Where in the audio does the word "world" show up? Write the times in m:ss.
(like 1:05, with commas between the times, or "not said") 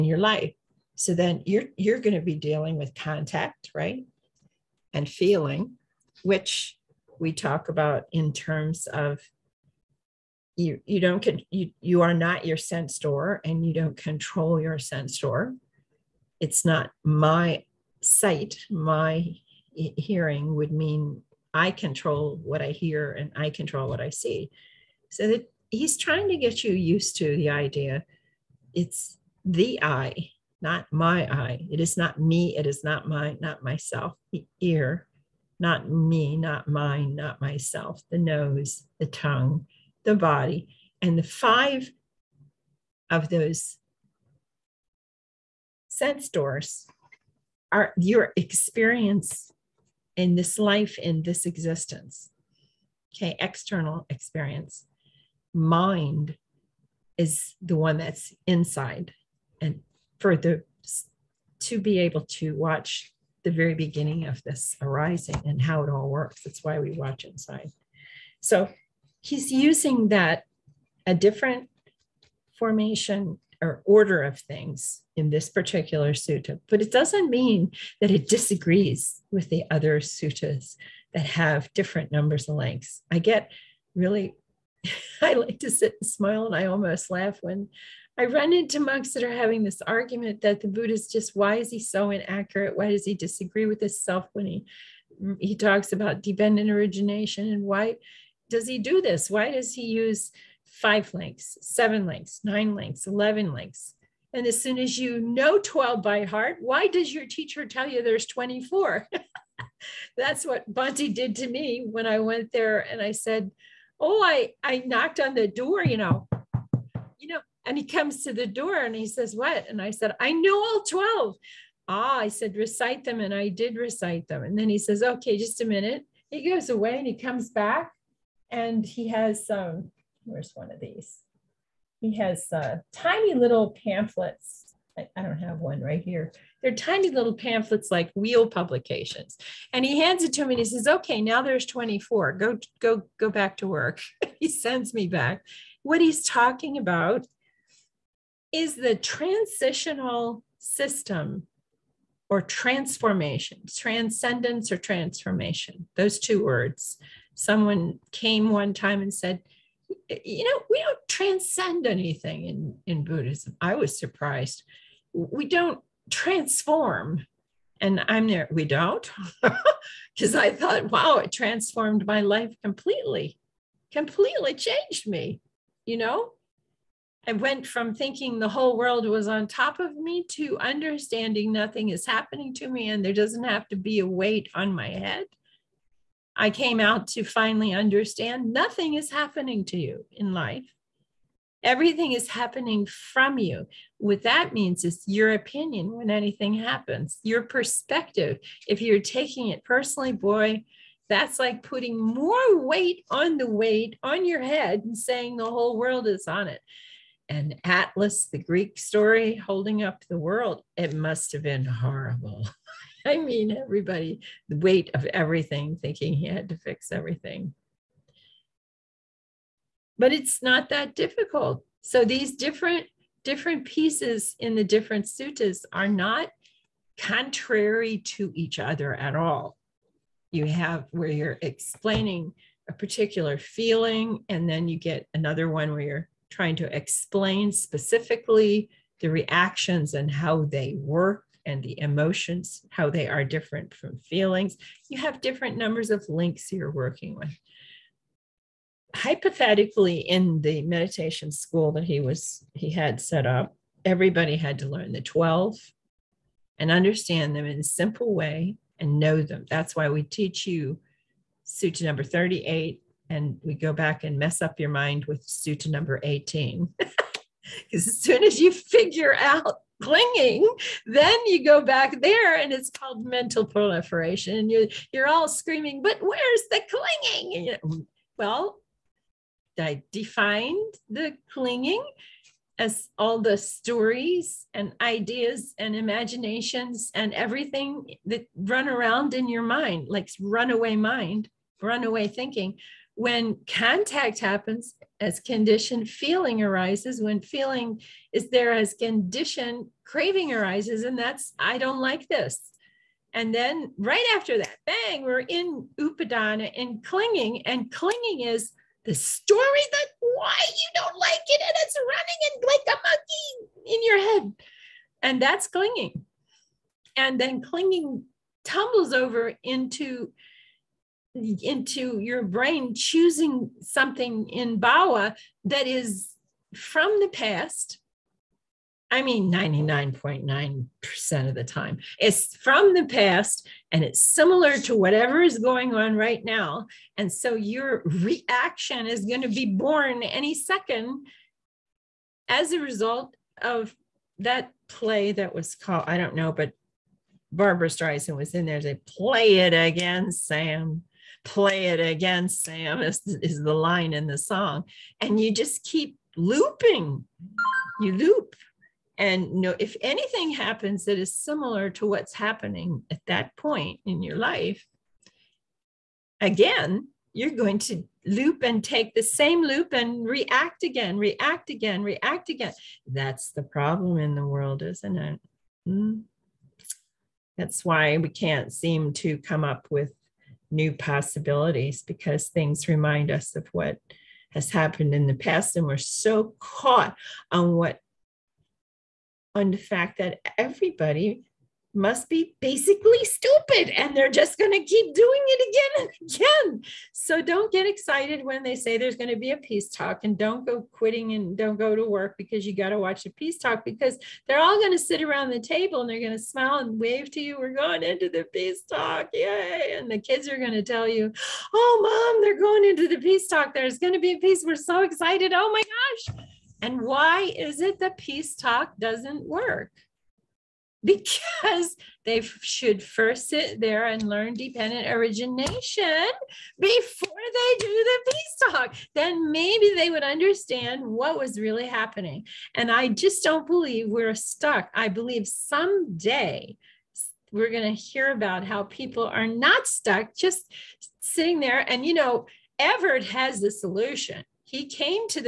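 2:58, 3:25, 3:30, 6:14.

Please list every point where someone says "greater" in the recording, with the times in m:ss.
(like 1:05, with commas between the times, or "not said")
not said.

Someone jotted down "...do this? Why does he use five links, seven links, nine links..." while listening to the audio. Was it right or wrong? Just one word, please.
right.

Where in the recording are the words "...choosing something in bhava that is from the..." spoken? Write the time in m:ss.
5:22.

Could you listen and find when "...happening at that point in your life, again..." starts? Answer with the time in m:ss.
6:02.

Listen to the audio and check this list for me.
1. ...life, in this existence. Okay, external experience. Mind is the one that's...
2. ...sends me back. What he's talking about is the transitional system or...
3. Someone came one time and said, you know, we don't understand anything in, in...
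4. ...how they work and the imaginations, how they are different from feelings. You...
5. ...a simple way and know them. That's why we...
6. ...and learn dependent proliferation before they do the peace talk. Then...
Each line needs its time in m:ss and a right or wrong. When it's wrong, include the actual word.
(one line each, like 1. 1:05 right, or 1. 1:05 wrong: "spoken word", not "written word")
1. 0:50 right
2. 2:24 right
3. 2:37 wrong: "transcend", not "understand"
4. 4:00 wrong: "emotions", not "imaginations"
5. 4:17 right
6. 7:03 wrong: "origination", not "proliferation".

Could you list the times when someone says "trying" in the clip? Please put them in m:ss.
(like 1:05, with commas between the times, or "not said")
0:25, 3:56.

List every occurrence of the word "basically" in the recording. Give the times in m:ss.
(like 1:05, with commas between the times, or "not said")
6:32.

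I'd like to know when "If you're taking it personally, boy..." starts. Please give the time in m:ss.
3:18.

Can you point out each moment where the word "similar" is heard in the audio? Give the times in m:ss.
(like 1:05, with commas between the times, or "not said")
5:34, 6:01.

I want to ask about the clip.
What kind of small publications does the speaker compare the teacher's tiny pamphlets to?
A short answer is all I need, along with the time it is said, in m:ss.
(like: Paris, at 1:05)
wheel publications, at 2:18.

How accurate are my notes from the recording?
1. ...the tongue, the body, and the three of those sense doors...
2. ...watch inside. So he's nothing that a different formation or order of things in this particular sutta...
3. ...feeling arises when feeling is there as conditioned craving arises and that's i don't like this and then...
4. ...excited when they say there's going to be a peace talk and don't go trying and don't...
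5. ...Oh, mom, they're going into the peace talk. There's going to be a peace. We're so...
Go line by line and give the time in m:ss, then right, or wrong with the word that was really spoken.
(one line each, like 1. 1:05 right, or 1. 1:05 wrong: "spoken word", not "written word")
1. 0:38 wrong: "five", not "three"
2. 1:06 wrong: "using", not "nothing"
3. 4:55 right
4. 6:37 wrong: "quitting", not "trying"
5. 6:51 right.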